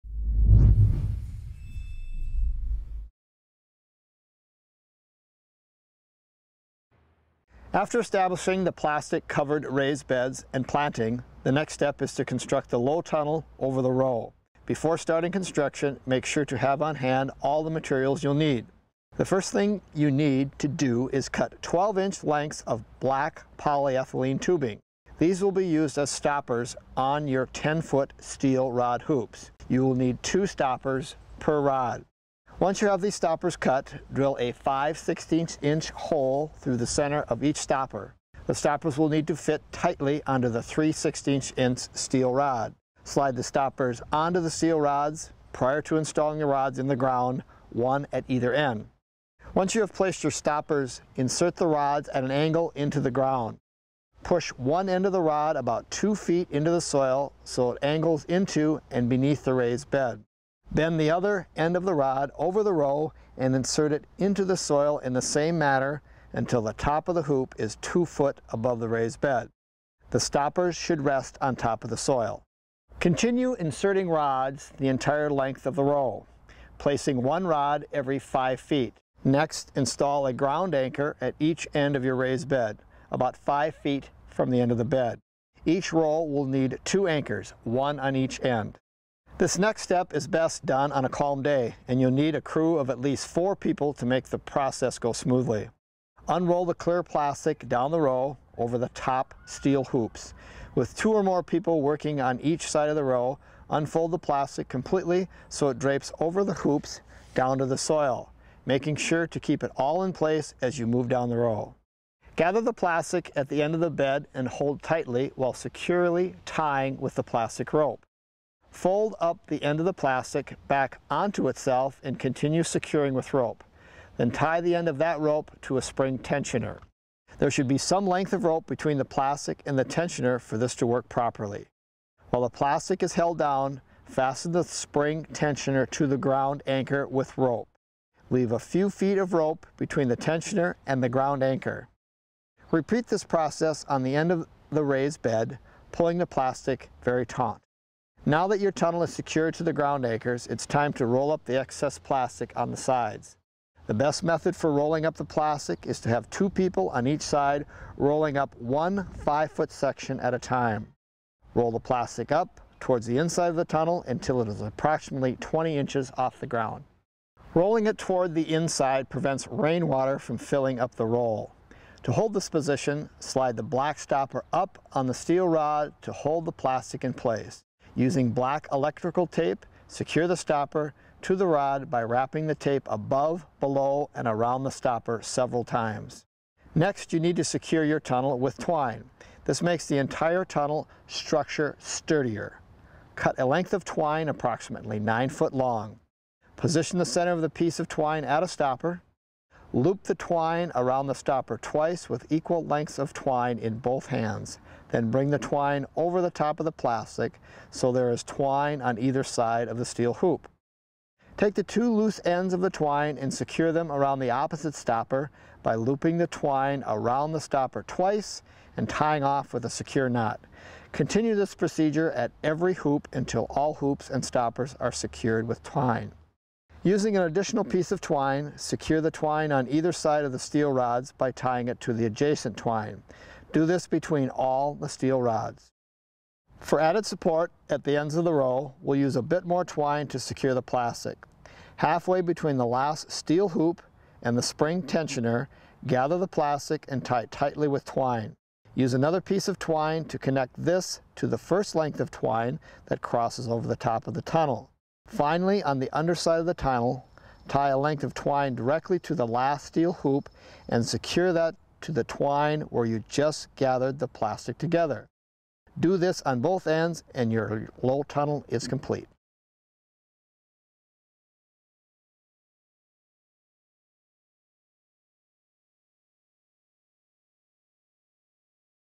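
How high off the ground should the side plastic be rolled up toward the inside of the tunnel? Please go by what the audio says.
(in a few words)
20 inches.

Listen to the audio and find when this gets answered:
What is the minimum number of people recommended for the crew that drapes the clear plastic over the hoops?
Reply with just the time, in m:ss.
1:33.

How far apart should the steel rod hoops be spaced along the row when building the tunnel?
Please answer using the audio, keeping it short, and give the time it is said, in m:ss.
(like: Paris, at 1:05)
every 5 feet, at 1:17.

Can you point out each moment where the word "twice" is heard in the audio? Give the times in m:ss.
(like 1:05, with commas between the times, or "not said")
3:21, 3:37.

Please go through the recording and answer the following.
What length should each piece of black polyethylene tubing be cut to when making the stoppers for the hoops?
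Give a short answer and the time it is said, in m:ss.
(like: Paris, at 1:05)
12 inch, at 0:21.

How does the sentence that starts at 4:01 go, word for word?
Halfway between the last steel hoop and the spring tensioner, gather the plastic and tie it tightly with twine.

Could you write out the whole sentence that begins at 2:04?
Then tie the end of that rope to a spring tensioner.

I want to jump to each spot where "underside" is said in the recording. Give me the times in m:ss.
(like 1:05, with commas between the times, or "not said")
4:15.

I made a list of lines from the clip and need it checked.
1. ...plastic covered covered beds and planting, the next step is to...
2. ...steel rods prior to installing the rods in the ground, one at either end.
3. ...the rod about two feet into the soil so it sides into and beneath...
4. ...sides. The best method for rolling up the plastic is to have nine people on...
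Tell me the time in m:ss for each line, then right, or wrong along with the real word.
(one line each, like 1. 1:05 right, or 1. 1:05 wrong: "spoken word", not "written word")
1. 0:08 wrong: "raised", not "covered"
2. 0:44 right
3. 0:55 wrong: "angles", not "sides"
4. 2:32 wrong: "two", not "nine".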